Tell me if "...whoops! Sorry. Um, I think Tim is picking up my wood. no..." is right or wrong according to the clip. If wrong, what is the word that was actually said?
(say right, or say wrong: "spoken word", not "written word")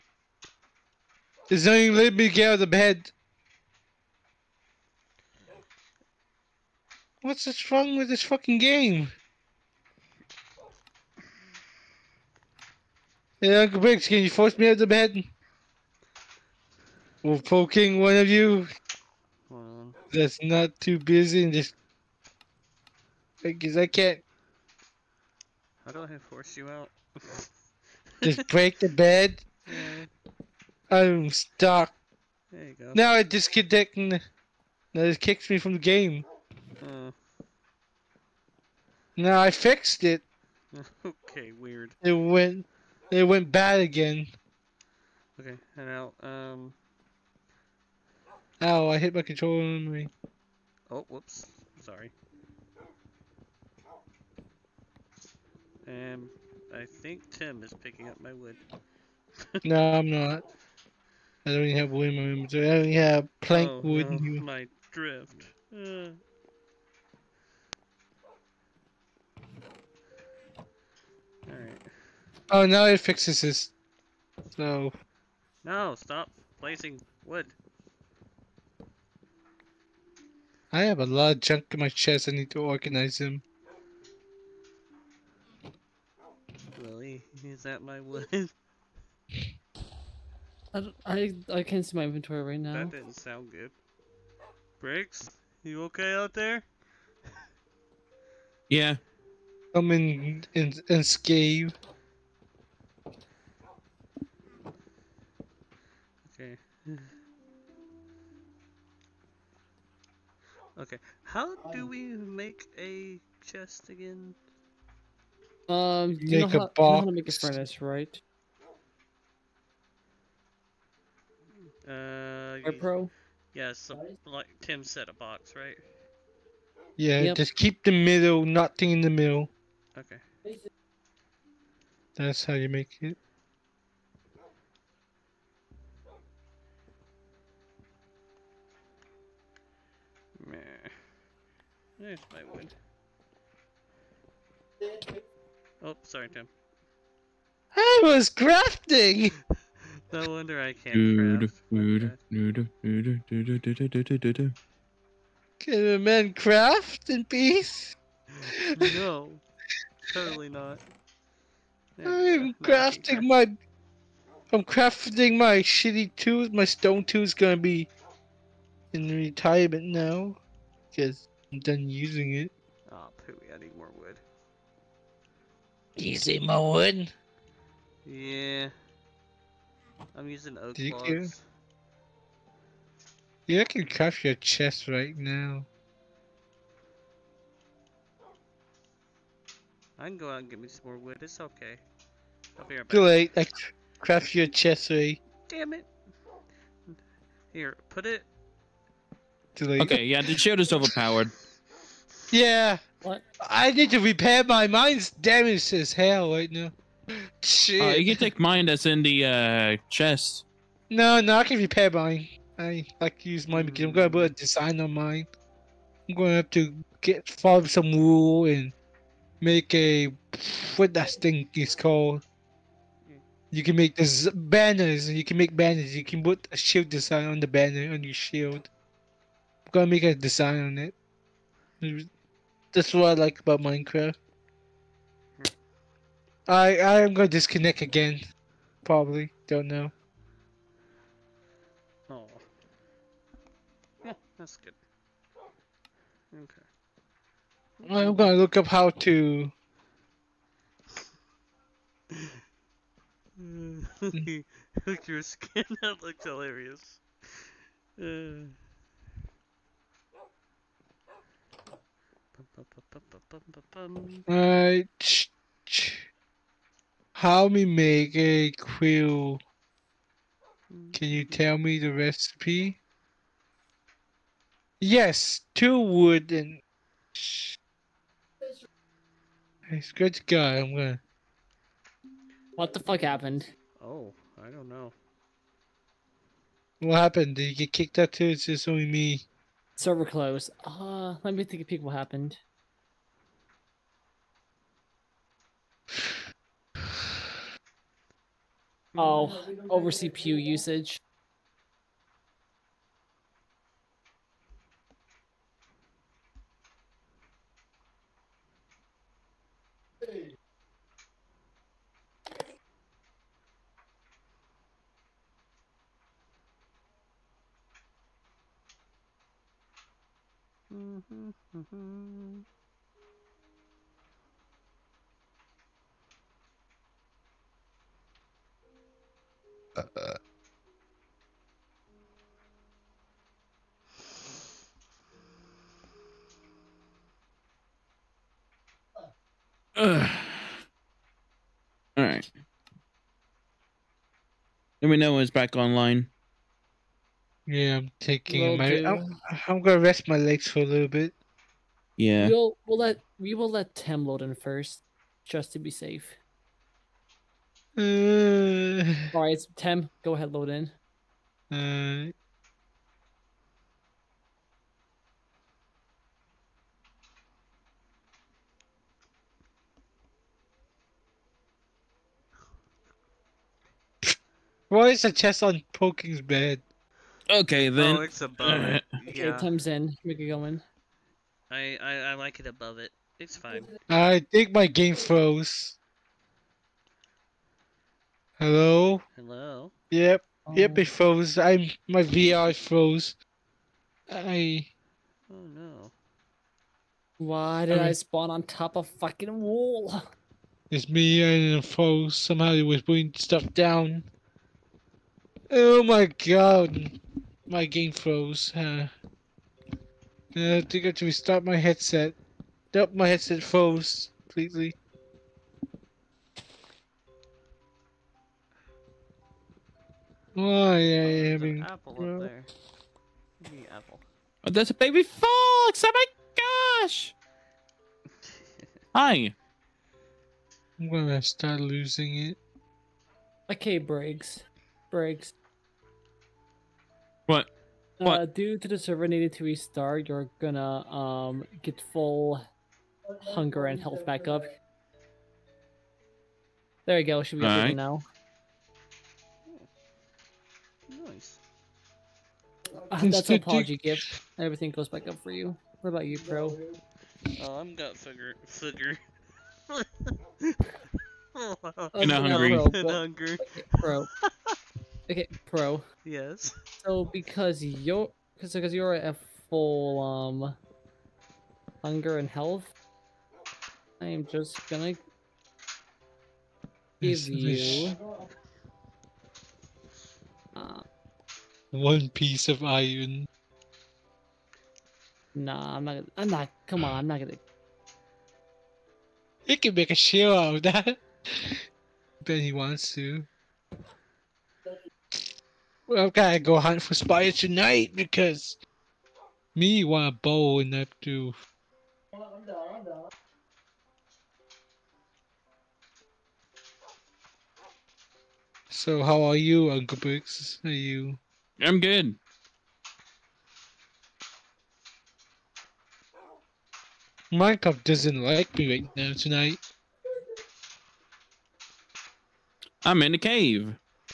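right.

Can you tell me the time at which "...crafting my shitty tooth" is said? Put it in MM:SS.
02:44.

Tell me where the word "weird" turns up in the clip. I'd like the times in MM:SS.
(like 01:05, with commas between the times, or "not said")
00:41.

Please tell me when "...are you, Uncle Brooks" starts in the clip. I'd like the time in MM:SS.
08:29.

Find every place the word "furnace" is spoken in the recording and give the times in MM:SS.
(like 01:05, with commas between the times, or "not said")
01:57.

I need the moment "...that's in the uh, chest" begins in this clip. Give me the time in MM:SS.
03:28.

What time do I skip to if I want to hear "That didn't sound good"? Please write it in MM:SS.
01:32.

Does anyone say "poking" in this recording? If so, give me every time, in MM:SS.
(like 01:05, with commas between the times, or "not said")
00:17, 06:15.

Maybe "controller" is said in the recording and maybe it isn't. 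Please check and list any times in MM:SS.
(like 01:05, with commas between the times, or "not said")
00:49.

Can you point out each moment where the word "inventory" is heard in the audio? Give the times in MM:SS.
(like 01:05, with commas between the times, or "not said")
01:02, 01:32.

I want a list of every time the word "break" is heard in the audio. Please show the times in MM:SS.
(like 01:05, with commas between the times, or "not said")
00:28.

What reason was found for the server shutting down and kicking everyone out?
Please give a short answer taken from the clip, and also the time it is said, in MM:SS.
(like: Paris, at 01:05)
Over CPU usage, at 04:59.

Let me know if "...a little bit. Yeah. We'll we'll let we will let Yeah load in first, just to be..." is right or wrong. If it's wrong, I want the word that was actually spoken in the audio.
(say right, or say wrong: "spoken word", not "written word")
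wrong: "Tem", not "Yeah".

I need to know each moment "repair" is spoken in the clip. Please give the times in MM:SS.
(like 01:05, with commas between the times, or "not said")
03:23, 03:31.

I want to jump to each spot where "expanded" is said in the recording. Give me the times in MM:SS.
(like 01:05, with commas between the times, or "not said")
not said.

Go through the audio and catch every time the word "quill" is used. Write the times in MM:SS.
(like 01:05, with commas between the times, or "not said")
04:28.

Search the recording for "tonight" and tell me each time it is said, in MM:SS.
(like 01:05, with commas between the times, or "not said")
08:17, 08:39.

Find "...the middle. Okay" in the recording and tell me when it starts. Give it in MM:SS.
02:09.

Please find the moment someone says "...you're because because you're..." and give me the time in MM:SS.
07:47.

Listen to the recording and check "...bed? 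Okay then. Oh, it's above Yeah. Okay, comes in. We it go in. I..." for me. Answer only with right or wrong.
right.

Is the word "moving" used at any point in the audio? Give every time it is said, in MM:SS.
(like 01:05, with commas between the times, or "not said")
not said.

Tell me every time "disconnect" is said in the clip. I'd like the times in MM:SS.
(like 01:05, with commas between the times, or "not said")
00:33, 03:57.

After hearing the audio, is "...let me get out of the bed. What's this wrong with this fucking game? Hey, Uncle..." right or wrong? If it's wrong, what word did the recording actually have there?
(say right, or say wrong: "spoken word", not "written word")
right.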